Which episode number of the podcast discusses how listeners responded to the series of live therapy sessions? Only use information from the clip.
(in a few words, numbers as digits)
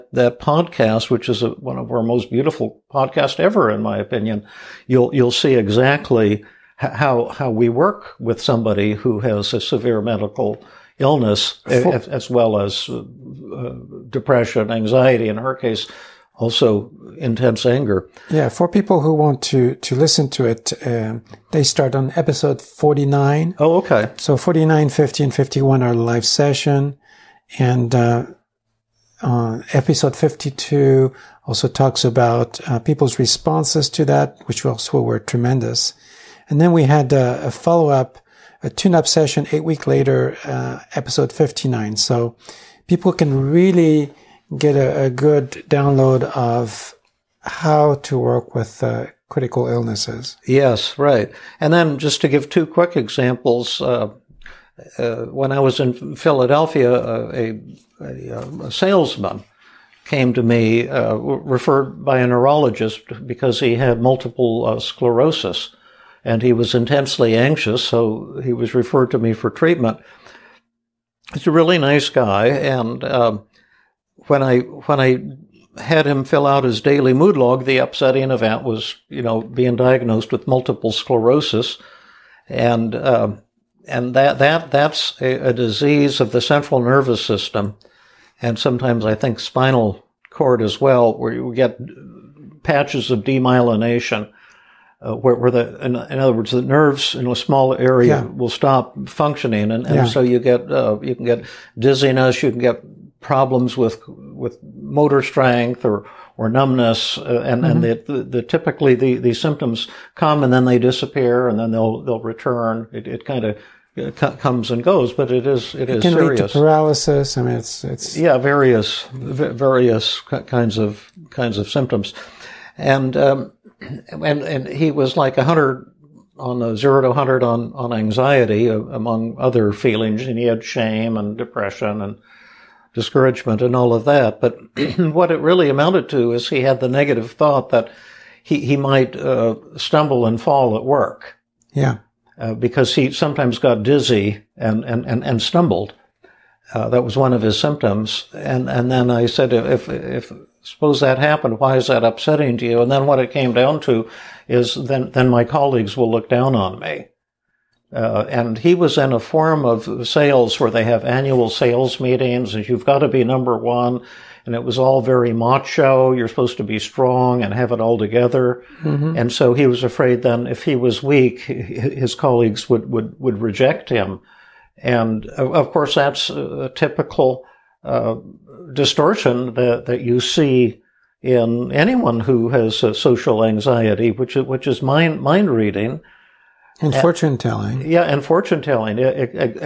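52.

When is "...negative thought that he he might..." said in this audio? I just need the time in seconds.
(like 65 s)
136 s.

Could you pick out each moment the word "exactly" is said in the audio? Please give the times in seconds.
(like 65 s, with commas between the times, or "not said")
5 s, 189 s.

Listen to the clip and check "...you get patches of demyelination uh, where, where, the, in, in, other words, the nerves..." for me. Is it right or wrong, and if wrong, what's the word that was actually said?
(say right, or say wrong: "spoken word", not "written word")
right.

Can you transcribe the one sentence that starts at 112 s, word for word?
It, it kind of uh, c- comes and goes, but it is it, it is can serious.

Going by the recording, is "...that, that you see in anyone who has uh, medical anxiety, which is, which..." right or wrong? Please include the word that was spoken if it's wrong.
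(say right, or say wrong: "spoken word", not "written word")
wrong: "social", not "medical".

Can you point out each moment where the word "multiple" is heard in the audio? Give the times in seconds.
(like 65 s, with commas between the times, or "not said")
64 s, 80 s.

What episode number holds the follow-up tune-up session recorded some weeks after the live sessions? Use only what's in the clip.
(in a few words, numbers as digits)
59.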